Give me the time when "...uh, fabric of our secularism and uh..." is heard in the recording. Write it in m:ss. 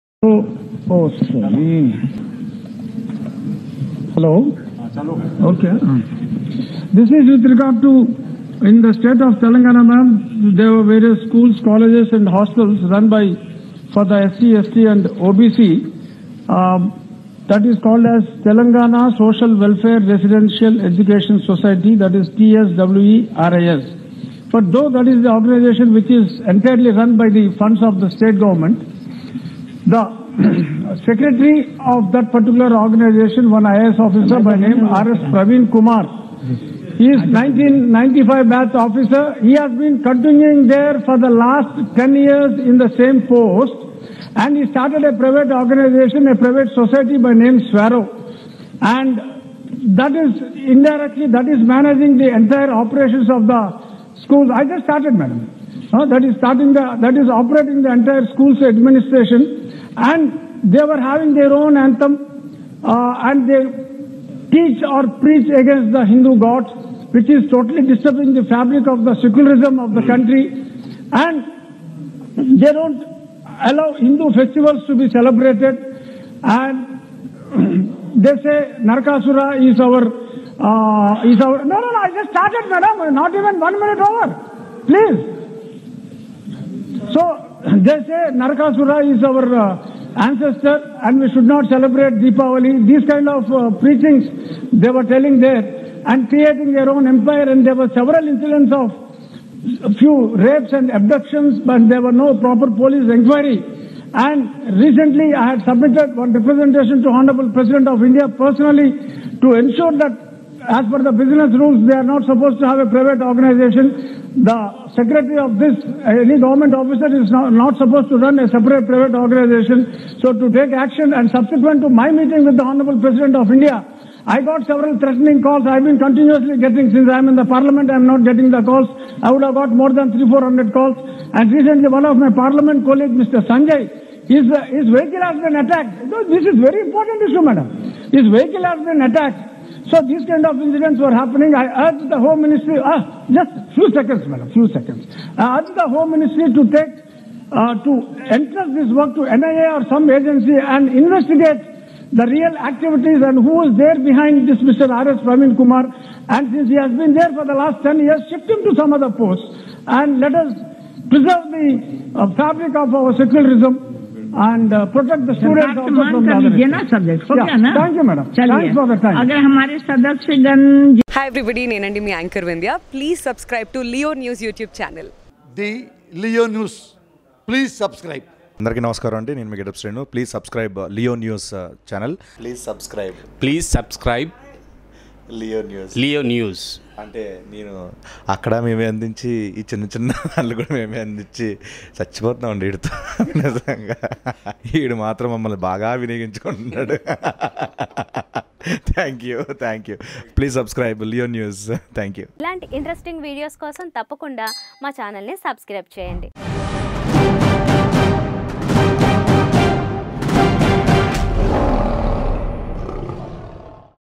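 2:42.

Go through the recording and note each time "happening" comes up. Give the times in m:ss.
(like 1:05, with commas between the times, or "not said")
2:21.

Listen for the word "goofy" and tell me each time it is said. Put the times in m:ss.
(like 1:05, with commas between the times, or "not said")
not said.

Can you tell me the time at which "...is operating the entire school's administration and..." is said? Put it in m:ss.
0:57.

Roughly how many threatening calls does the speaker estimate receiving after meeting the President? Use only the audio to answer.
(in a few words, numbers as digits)
300 to 400.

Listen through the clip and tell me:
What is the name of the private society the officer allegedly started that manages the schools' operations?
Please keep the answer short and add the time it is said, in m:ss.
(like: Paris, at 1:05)
Swarrow, at 0:47.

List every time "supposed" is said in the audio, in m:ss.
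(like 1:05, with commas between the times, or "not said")
1:52, 1:57.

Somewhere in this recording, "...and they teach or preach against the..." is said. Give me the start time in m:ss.
1:03.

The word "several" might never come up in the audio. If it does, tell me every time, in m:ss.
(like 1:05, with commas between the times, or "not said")
1:37, 2:04.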